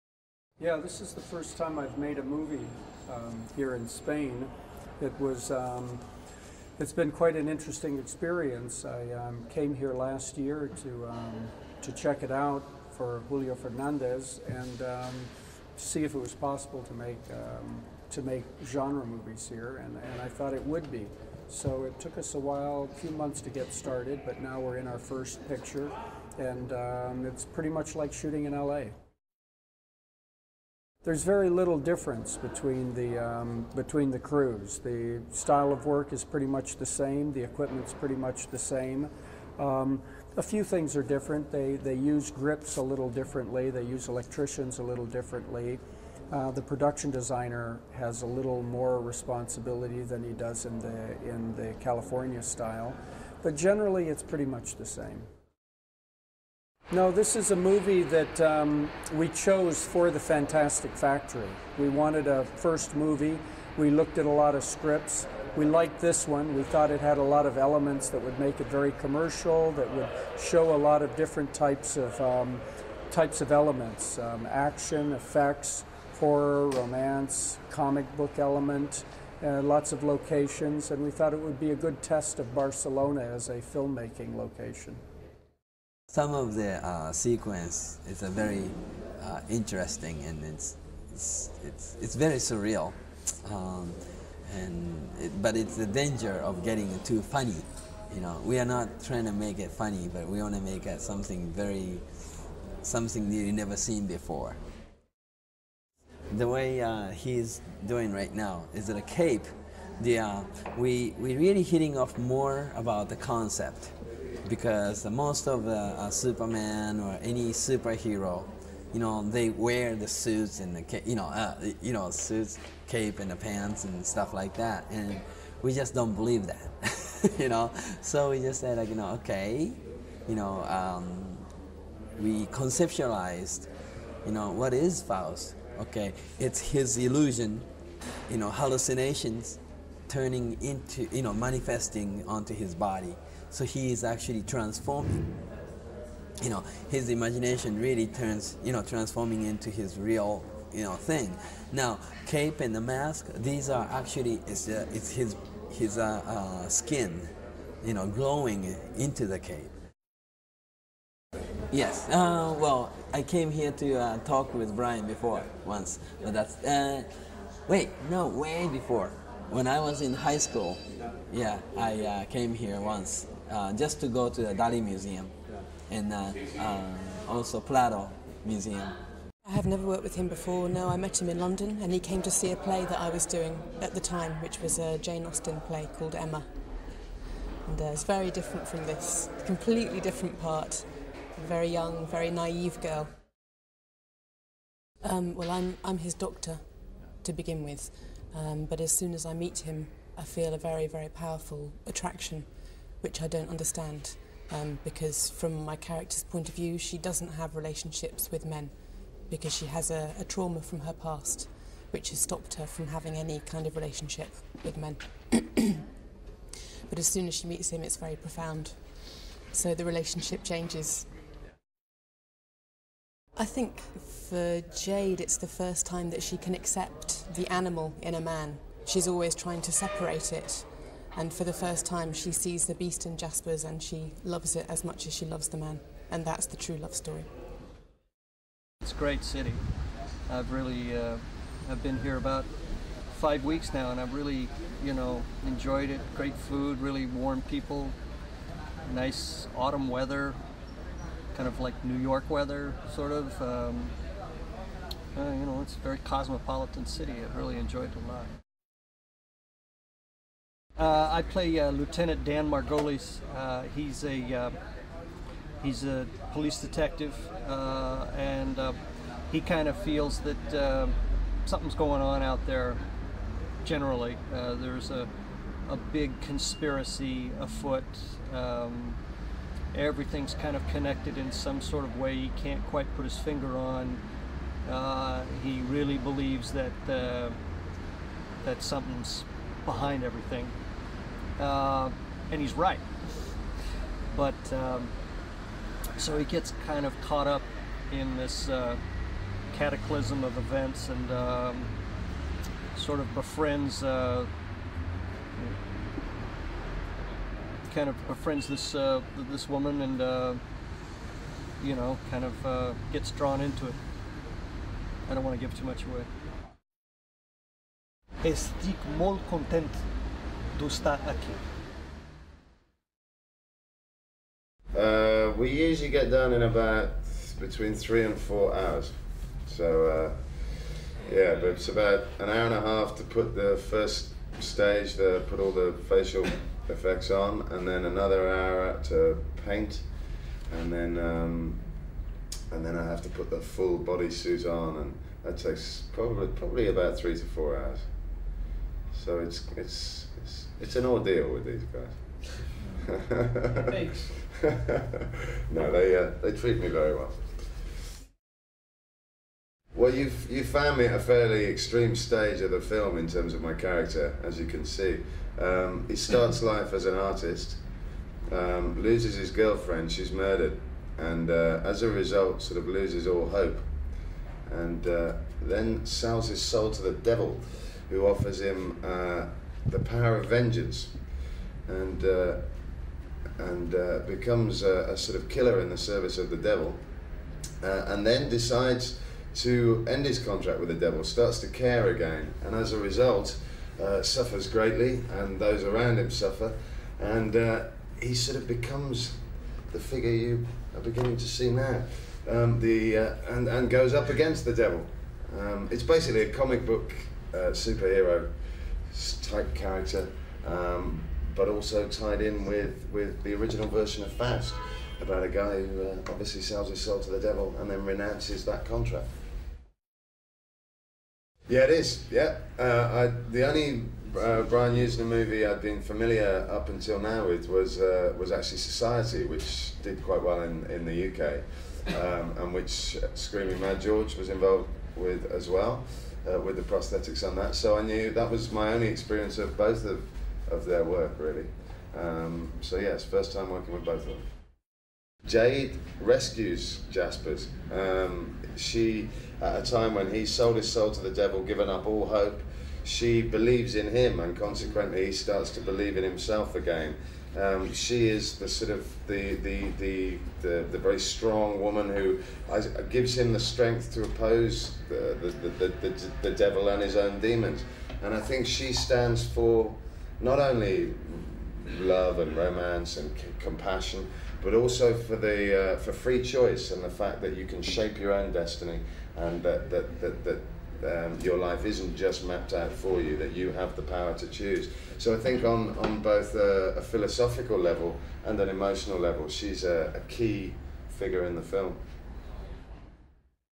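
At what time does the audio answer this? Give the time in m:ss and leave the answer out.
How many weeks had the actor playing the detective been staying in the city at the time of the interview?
4:03.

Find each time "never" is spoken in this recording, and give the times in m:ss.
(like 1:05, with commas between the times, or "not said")
1:43, 2:59.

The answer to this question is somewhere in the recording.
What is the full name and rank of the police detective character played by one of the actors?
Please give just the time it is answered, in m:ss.
4:21.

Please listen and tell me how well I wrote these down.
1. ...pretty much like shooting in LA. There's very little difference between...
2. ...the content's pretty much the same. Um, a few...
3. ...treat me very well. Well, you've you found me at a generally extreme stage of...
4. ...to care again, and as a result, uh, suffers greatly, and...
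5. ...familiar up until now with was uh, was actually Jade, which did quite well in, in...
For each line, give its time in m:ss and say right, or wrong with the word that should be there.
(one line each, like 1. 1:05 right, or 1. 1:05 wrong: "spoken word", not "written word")
1. 0:27 right
2. 0:37 wrong: "equipment", not "content"
3. 5:56 wrong: "fairly", not "generally"
4. 6:31 right
5. 7:05 wrong: "Society", not "Jade".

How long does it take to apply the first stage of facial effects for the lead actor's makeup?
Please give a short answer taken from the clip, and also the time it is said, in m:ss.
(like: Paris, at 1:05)
an hour and a half, at 5:32.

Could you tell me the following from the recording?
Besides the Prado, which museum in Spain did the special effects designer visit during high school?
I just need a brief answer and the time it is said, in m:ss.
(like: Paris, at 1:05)
Dali Museum, at 2:54.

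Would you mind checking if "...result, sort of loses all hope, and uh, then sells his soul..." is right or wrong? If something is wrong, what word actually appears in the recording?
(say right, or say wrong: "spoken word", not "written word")
right.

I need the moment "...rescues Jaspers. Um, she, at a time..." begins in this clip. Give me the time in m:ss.
7:25.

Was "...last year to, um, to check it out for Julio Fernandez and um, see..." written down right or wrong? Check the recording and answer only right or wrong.
right.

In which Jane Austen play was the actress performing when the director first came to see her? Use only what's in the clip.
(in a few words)
Emma.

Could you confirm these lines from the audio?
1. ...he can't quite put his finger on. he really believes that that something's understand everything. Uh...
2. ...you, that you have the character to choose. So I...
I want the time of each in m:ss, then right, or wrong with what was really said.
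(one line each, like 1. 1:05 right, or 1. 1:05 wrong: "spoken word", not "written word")
1. 4:42 wrong: "behind", not "understand"
2. 8:03 wrong: "power", not "character".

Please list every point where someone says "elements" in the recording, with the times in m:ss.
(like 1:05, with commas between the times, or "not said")
1:07, 1:13, 1:18.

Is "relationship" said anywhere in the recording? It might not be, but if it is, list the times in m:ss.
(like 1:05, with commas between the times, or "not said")
3:27, 3:33, 3:39.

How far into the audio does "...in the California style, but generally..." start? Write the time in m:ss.
0:51.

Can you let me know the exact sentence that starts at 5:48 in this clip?
So it's it's it's, it's an ordeal with these guys.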